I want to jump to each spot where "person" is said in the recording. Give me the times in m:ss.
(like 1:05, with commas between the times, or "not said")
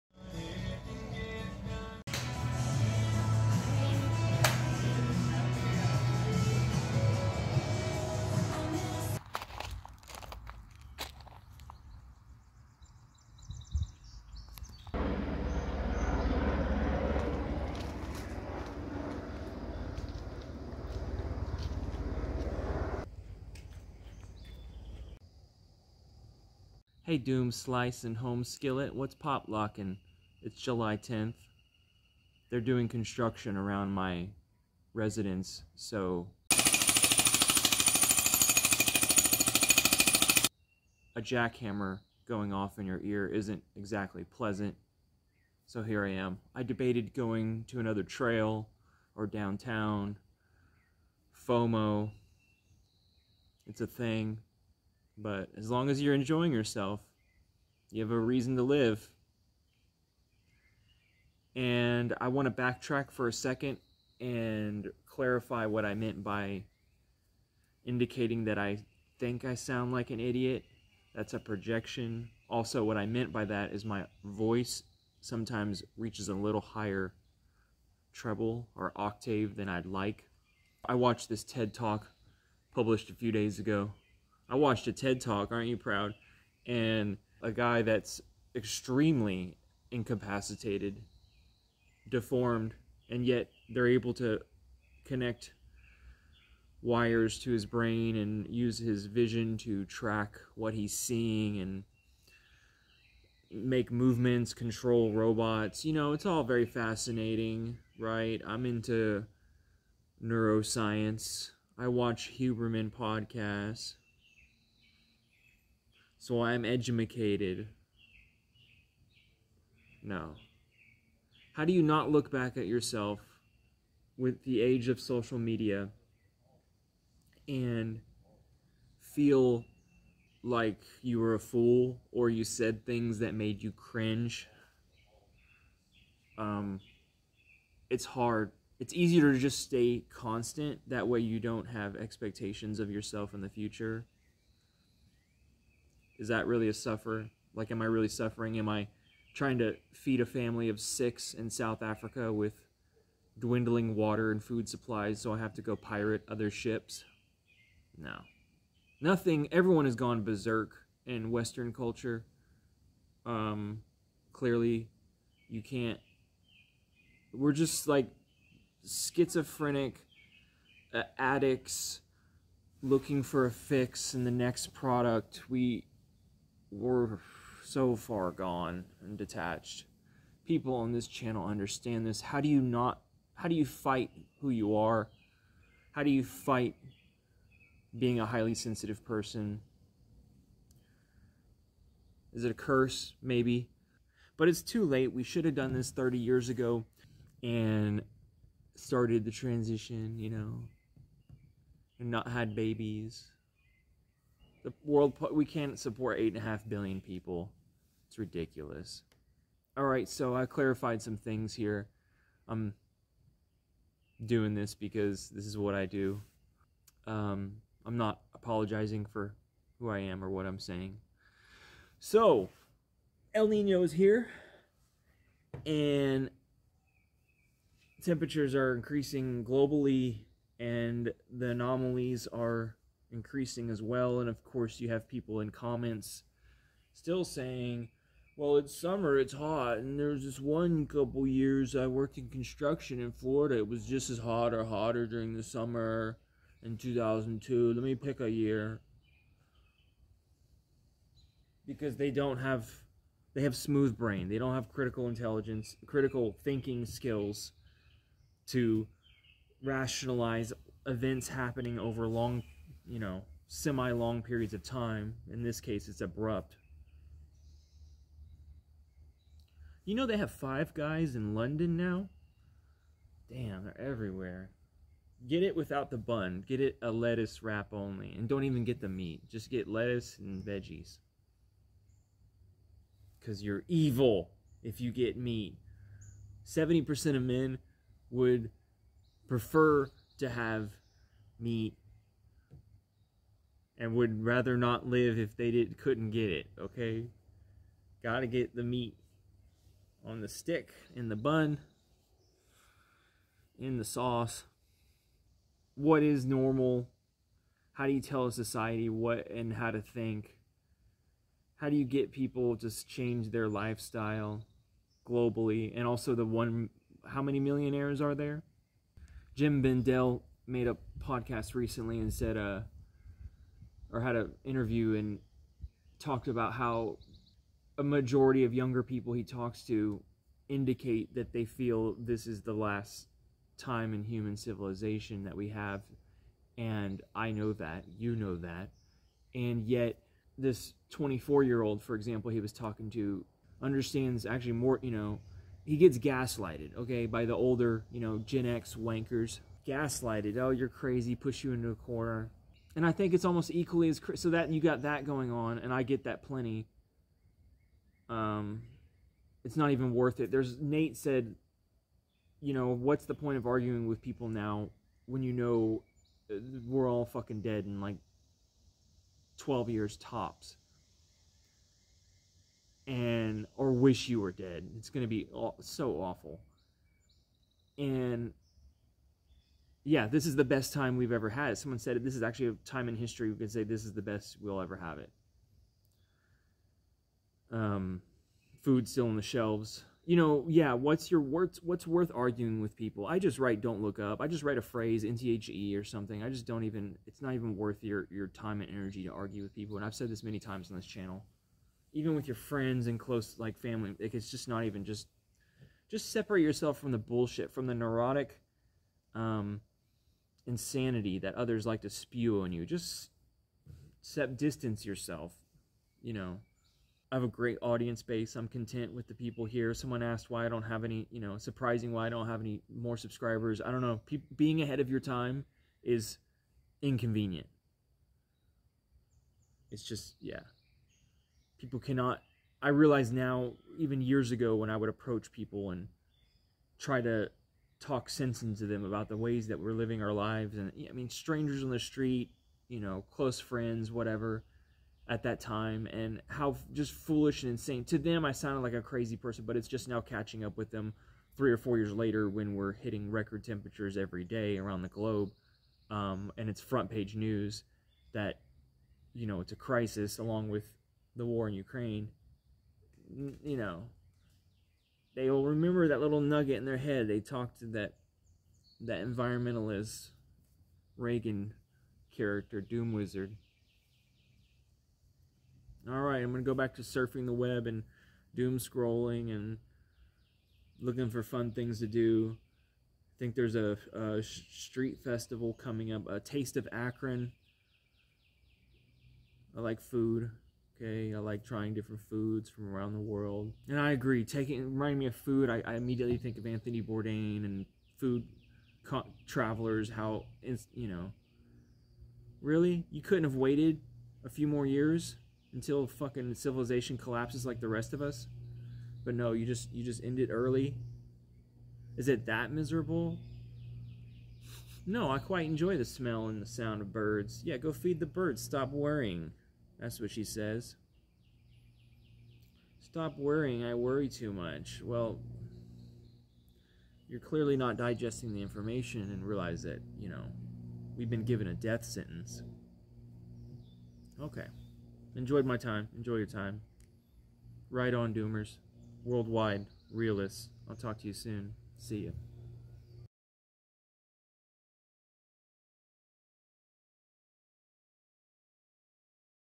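3:09, 7:29.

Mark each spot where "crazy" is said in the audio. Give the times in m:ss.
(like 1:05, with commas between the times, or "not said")
5:50, 7:28.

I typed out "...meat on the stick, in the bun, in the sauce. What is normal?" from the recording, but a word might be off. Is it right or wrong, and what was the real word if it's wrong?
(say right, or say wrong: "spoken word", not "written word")
right.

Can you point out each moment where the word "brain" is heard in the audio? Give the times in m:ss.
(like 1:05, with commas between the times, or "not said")
1:37, 4:13.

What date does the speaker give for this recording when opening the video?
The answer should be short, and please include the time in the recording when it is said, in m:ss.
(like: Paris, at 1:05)
July 10th, at 0:30.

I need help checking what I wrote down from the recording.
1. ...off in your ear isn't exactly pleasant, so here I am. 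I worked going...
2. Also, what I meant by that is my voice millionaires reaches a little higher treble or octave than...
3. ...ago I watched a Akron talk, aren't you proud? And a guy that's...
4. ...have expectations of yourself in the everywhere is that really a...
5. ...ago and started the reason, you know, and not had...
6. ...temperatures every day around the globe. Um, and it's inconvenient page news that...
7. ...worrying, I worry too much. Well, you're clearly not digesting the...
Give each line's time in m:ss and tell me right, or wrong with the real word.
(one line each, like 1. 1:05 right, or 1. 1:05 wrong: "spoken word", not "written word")
1. 0:42 wrong: "debated", not "worked"
2. 1:12 wrong: "sometimes", not "millionaires"
3. 1:23 wrong: "TED", not "Akron"
4. 2:21 wrong: "future", not "everywhere"
5. 3:16 wrong: "transition", not "reason"
6. 7:33 wrong: "front", not "inconvenient"
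7. 8:43 right.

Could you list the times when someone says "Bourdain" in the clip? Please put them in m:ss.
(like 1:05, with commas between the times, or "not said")
8:16.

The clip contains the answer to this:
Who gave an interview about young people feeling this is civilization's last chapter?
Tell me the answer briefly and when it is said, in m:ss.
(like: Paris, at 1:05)
Jem Bendell, at 5:19.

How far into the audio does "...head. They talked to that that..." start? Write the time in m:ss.
7:46.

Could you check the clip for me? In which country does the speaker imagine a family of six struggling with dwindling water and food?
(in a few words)
South Africa.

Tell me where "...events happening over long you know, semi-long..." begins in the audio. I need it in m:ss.
4:20.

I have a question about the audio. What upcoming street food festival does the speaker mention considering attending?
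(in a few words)
Taste of Akron.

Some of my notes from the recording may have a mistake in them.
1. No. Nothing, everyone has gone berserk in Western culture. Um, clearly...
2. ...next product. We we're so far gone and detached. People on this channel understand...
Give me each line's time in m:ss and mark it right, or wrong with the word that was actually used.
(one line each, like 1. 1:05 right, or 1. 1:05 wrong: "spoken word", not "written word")
1. 2:37 right
2. 2:54 right.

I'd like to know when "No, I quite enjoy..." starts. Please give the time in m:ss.
8:34.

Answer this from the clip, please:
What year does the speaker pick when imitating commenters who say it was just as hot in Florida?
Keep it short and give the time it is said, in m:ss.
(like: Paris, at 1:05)
2002, at 4:06.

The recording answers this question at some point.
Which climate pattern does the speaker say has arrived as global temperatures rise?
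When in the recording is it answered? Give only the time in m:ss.
3:43.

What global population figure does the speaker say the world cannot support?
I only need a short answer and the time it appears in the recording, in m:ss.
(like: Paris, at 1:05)
8.5 billion, at 3:26.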